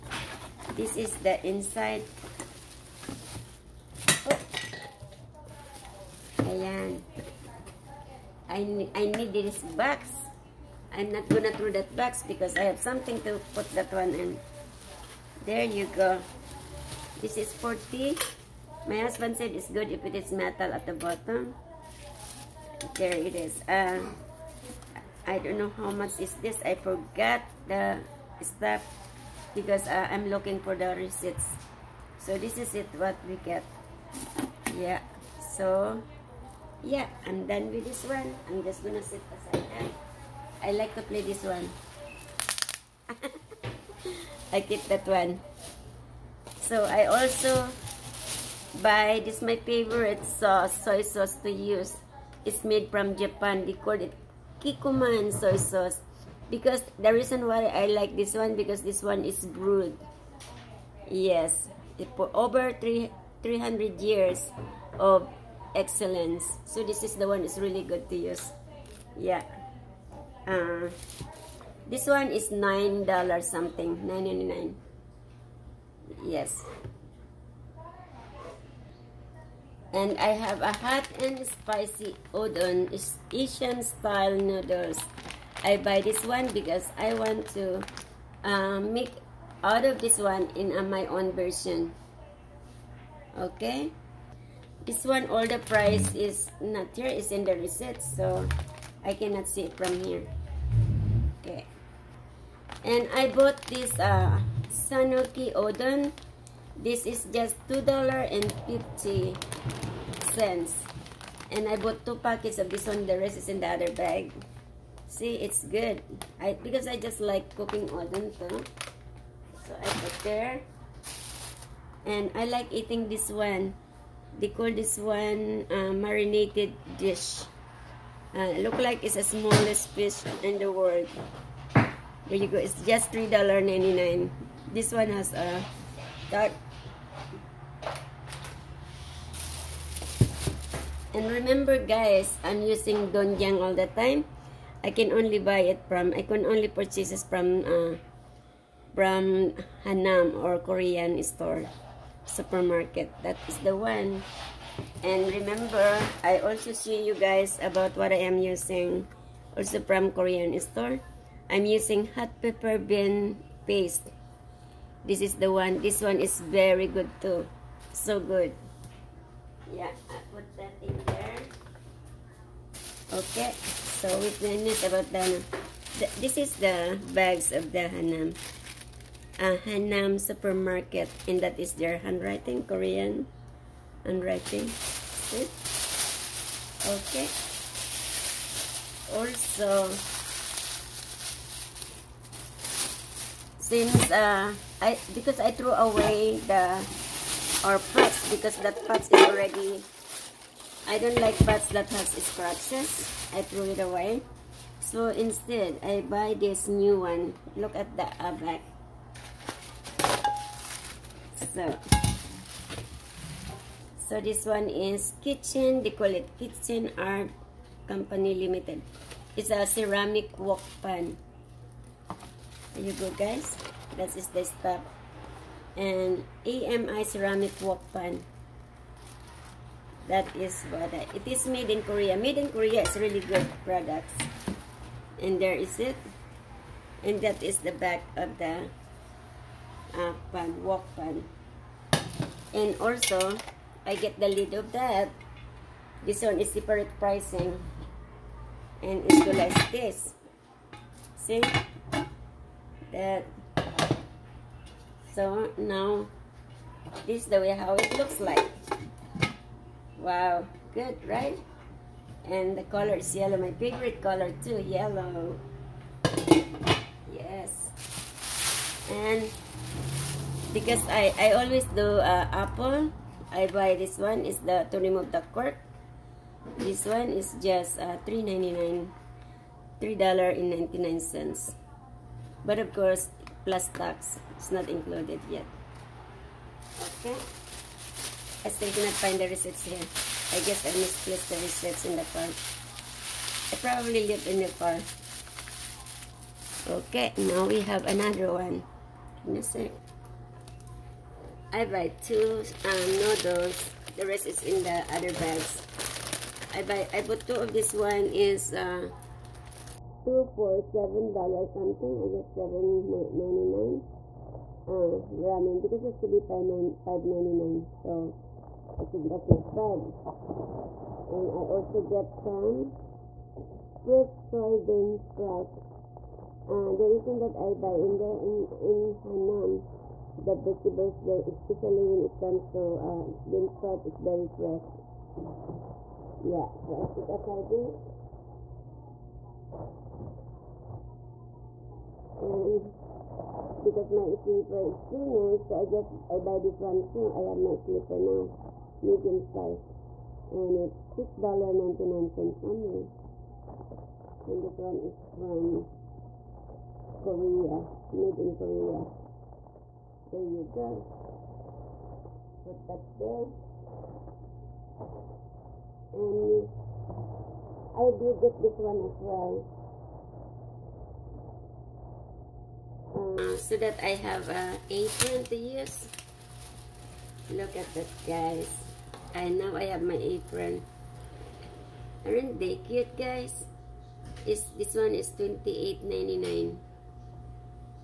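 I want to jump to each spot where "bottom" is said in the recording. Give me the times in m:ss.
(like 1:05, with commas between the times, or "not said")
0:20.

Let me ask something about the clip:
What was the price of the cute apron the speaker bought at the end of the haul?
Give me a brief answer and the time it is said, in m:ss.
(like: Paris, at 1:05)
$28.99, at 6:25.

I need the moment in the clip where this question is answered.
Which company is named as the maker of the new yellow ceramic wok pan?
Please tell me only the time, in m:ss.
3:36.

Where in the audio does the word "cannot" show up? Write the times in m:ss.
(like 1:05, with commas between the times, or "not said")
1:39, 4:48.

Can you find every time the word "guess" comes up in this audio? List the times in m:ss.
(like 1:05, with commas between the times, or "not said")
4:50, 5:12.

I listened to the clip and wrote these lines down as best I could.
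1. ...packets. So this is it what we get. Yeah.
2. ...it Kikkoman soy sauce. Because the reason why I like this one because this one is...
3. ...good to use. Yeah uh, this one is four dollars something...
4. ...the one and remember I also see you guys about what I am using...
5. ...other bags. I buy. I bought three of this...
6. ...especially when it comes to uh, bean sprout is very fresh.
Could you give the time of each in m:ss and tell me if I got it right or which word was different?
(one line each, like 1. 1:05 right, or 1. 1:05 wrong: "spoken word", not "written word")
1. 0:30 wrong: "receipts", not "packets"
2. 0:53 right
3. 1:07 wrong: "nine", not "four"
4. 2:33 right
5. 5:04 wrong: "two", not "three"
6. 5:31 right.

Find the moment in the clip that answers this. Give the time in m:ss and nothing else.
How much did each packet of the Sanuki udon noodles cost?
1:47.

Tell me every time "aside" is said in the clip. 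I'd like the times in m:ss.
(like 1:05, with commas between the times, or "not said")
0:39, 5:37.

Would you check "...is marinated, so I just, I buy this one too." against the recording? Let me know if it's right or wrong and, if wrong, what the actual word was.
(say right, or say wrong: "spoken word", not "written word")
wrong: "finished", not "marinated".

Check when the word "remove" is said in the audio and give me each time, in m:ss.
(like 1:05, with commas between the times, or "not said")
4:34.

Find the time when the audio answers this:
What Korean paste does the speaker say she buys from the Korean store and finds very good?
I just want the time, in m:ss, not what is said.
2:42.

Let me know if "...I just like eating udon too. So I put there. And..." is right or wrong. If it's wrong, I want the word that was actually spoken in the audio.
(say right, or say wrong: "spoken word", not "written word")
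wrong: "cooking", not "eating".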